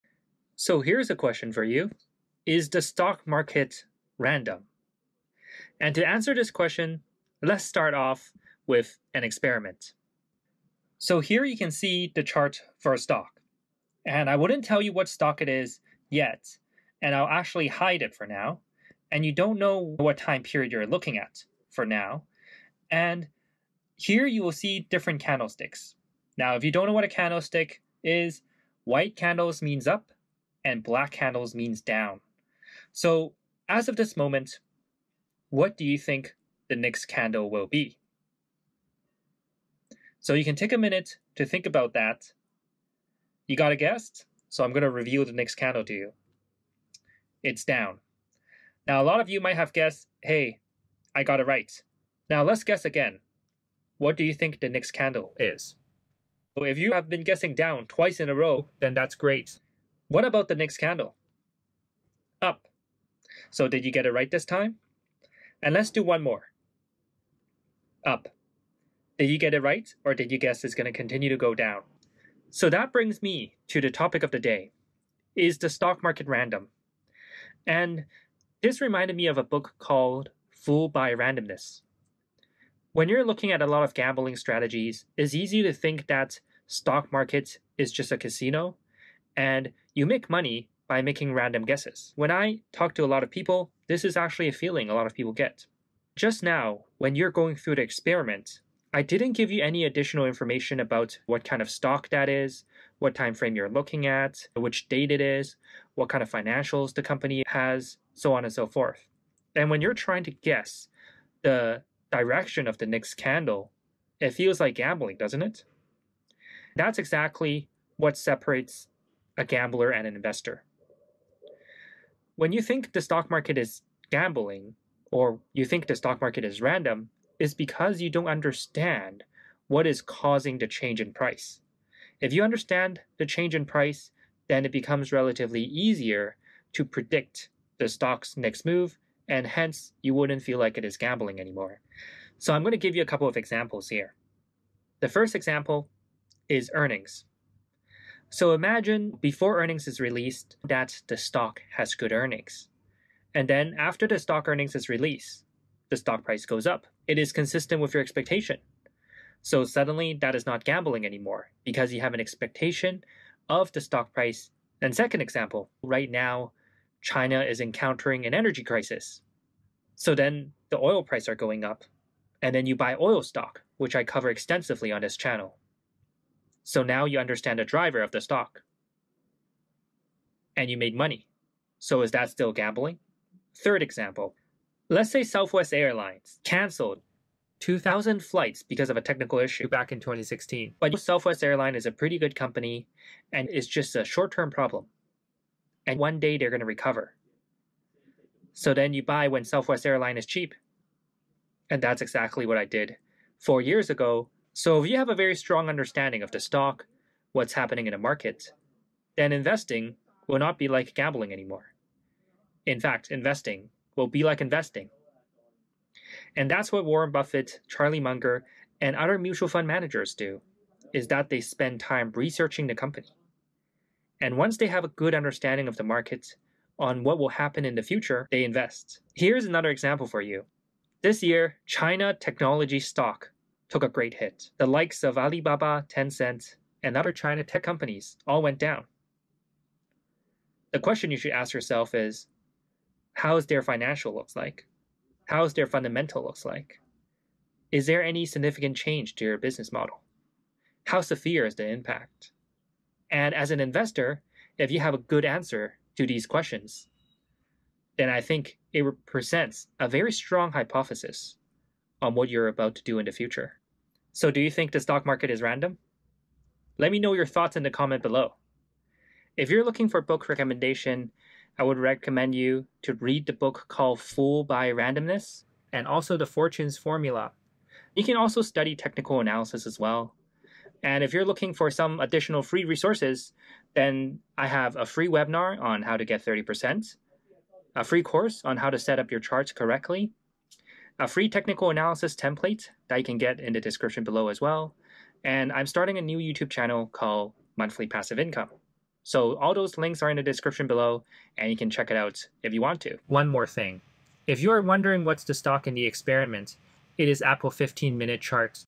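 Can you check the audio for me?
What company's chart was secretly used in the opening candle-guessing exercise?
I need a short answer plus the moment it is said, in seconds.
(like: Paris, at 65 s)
Apple, at 307 s.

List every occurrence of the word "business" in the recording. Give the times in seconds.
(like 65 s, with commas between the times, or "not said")
249 s.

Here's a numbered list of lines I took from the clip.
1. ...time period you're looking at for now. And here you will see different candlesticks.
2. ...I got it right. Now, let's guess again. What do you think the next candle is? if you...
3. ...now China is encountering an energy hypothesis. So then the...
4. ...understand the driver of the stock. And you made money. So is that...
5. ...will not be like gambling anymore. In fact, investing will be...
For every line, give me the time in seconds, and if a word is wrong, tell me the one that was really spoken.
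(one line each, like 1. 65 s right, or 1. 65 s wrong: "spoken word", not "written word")
1. 20 s right
2. 51 s right
3. 166 s wrong: "crisis", not "hypothesis"
4. 177 s right
5. 210 s right.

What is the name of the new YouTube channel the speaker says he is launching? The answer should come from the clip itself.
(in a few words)
Monthly Passive Income.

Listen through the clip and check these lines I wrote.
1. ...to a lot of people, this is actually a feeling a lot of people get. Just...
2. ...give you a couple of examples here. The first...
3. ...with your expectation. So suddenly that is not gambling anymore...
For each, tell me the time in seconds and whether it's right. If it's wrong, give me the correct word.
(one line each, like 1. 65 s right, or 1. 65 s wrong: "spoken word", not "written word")
1. 92 s right
2. 142 s right
3. 157 s right.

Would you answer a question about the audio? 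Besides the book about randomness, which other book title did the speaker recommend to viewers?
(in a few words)
The Fortune's Formula.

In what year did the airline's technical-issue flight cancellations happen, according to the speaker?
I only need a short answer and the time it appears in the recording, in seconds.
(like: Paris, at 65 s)
2016, at 190 s.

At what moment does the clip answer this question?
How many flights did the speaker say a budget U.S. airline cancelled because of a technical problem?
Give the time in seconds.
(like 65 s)
187 s.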